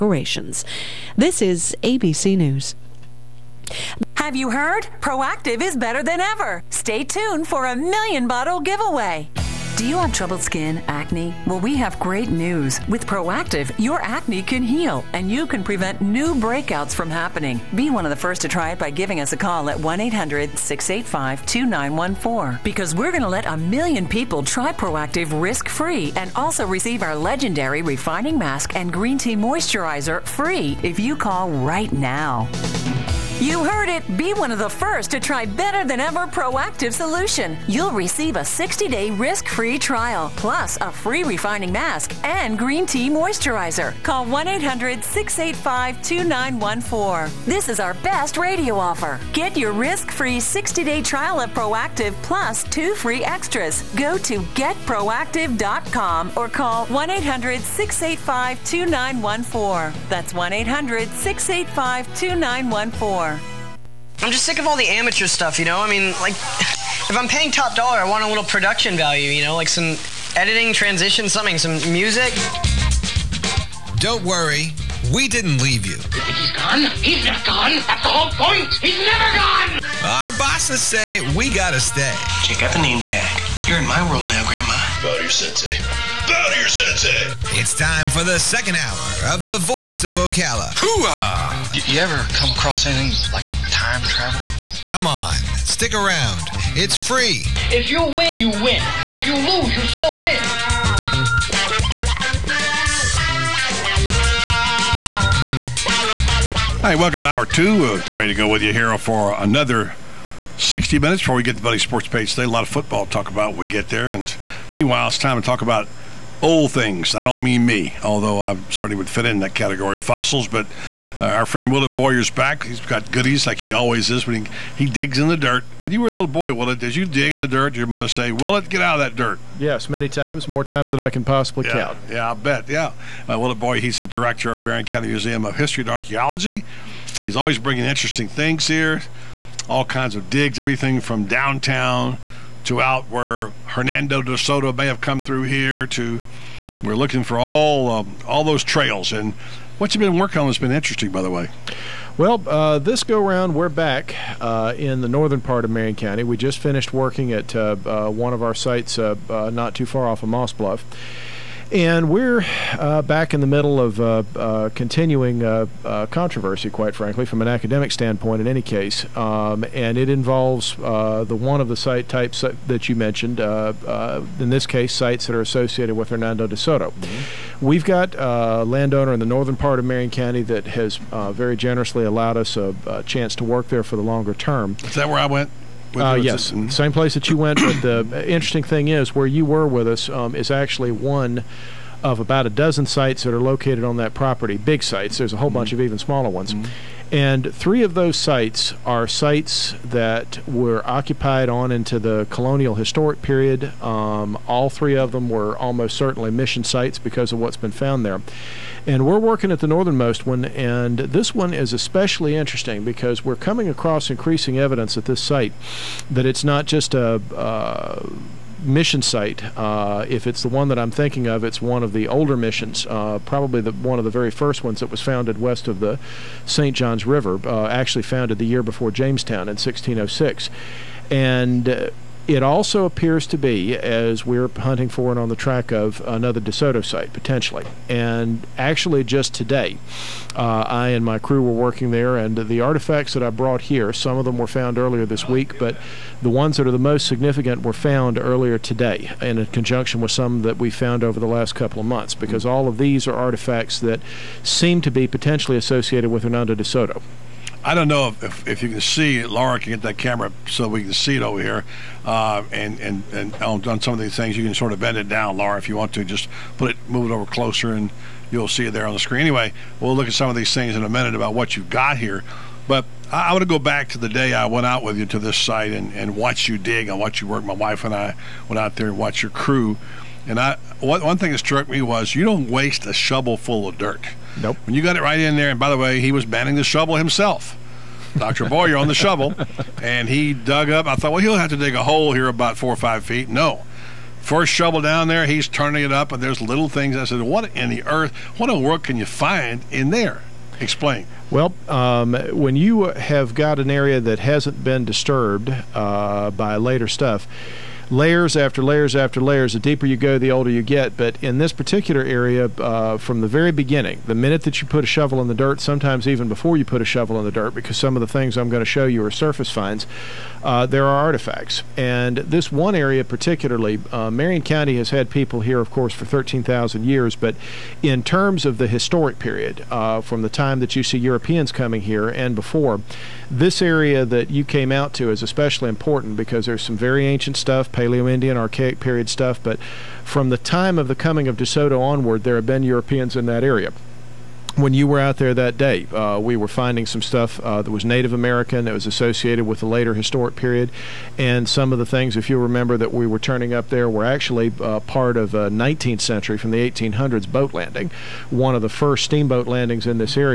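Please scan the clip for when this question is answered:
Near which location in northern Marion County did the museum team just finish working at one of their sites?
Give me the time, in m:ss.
2:40.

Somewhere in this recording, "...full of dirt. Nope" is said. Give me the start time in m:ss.
4:43.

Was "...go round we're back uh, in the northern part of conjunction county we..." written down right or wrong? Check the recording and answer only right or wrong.
wrong.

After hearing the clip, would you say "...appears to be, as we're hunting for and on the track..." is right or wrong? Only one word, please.
right.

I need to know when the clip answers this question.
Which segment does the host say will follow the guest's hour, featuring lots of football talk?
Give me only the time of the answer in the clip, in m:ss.
1:51.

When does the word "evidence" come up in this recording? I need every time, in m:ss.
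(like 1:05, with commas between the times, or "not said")
3:34.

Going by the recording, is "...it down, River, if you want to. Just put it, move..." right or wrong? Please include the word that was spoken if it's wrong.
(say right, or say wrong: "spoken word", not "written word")
wrong: "Laura", not "River".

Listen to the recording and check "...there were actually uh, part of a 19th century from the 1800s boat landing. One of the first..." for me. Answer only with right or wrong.
right.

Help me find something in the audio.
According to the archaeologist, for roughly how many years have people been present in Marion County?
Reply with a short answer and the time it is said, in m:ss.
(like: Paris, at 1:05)
13,000, at 5:26.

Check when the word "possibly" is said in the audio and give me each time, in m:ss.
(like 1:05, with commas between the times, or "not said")
2:11.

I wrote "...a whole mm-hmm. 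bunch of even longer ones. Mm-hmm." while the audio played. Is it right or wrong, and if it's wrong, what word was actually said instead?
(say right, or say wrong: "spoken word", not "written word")
wrong: "smaller", not "longer".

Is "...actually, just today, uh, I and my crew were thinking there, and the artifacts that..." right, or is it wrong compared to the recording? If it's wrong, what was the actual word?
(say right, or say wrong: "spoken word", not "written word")
wrong: "working", not "thinking".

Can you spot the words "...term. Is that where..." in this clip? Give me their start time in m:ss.
3:04.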